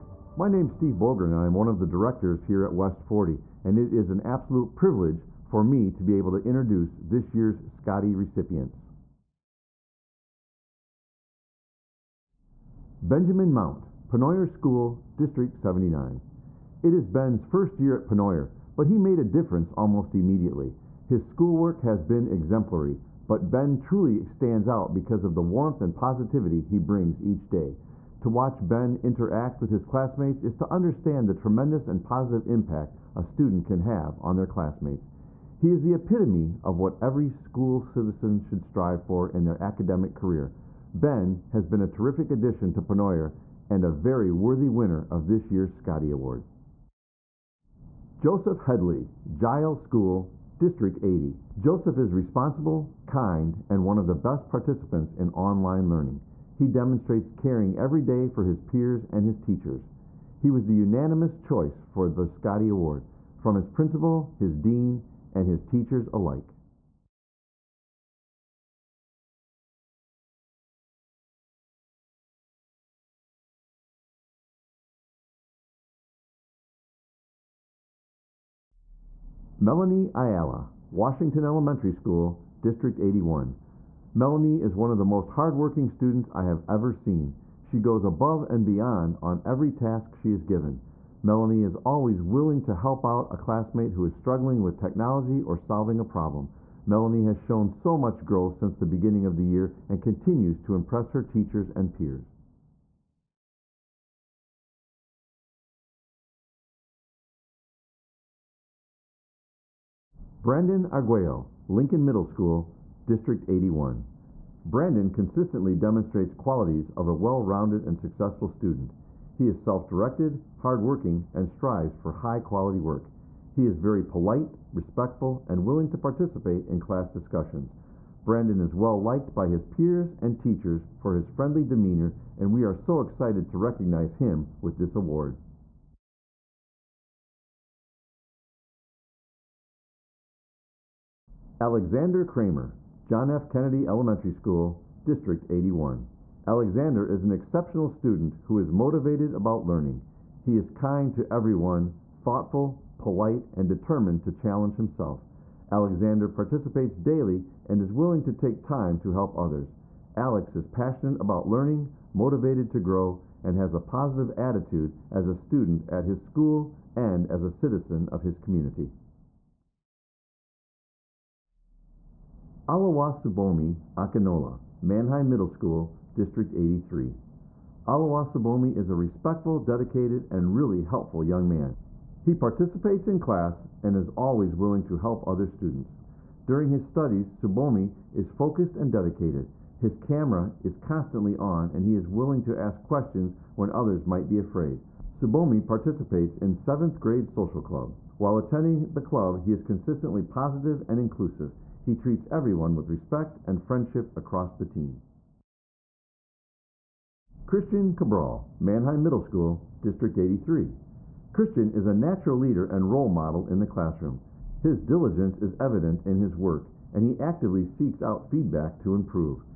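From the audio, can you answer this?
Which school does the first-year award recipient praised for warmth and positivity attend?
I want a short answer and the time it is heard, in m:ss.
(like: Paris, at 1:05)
Penoyer School, at 0:14.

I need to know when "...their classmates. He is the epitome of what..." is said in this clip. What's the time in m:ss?
0:34.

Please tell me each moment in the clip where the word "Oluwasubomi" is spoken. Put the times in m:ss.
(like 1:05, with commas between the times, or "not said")
2:52, 2:57.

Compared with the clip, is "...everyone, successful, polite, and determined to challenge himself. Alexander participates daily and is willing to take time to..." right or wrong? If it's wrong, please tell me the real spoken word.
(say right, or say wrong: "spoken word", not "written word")
wrong: "thoughtful", not "successful".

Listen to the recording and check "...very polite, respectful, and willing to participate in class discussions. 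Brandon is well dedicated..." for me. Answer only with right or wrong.
wrong.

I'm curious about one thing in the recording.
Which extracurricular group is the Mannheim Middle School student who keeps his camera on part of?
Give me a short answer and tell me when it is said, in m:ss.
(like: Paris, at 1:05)
7th grade social club, at 3:16.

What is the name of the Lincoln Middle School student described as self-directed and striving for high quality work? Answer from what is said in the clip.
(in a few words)
Brandon Arguello.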